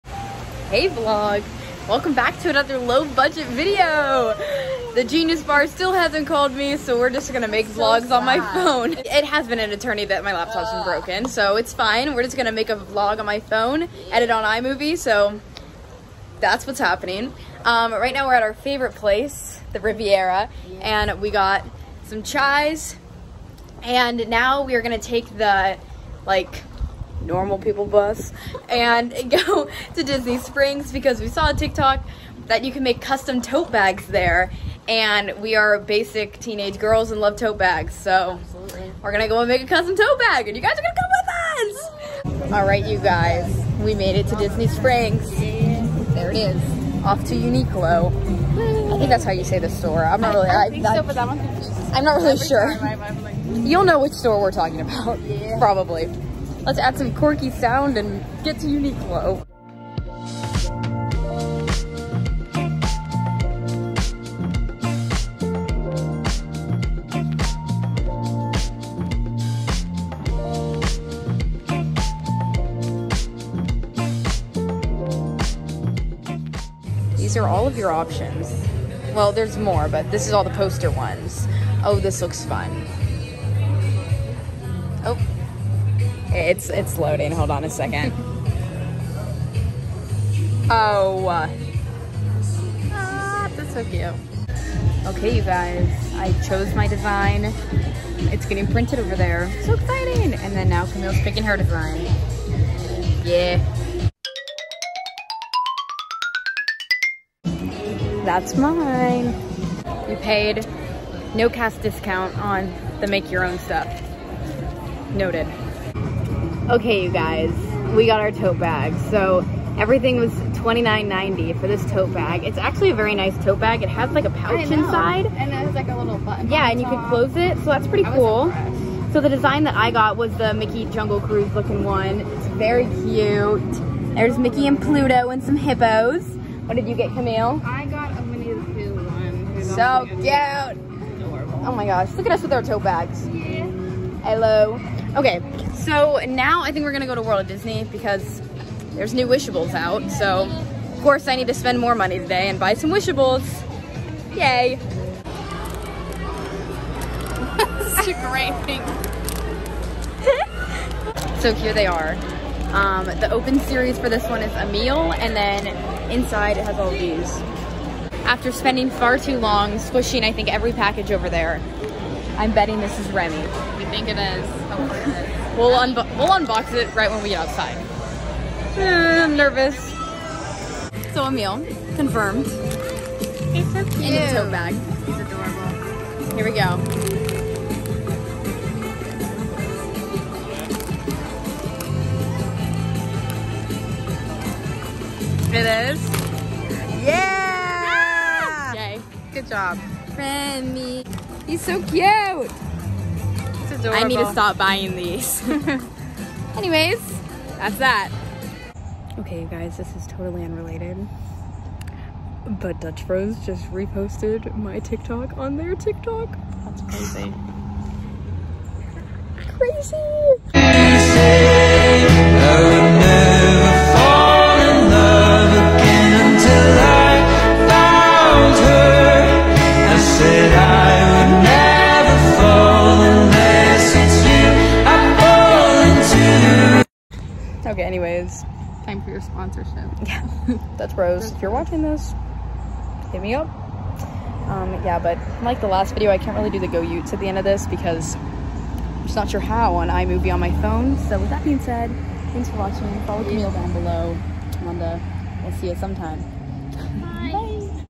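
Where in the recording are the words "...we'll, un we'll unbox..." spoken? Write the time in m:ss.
2:55.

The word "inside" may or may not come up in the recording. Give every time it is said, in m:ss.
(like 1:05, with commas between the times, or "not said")
2:04, 2:46.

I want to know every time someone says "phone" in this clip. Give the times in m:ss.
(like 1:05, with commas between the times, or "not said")
0:08, 0:13, 4:10.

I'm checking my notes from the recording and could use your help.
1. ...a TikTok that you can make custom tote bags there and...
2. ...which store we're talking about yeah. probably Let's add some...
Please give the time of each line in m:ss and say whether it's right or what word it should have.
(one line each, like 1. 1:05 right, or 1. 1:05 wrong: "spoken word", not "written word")
1. 0:31 right
2. 0:53 right.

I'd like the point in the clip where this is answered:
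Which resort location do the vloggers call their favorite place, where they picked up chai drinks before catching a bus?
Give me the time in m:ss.
0:19.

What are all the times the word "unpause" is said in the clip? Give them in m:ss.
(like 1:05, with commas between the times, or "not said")
not said.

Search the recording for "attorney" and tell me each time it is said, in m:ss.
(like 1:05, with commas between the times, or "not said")
0:09.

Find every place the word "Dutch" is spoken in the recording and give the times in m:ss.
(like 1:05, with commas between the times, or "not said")
3:32, 4:00.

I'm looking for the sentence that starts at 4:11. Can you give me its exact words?
So with that being said, thanks for watching.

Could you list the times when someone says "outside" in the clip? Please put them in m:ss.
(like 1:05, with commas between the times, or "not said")
2:57.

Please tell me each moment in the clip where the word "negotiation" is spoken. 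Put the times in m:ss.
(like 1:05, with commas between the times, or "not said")
not said.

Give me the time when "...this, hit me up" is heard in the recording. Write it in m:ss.
4:01.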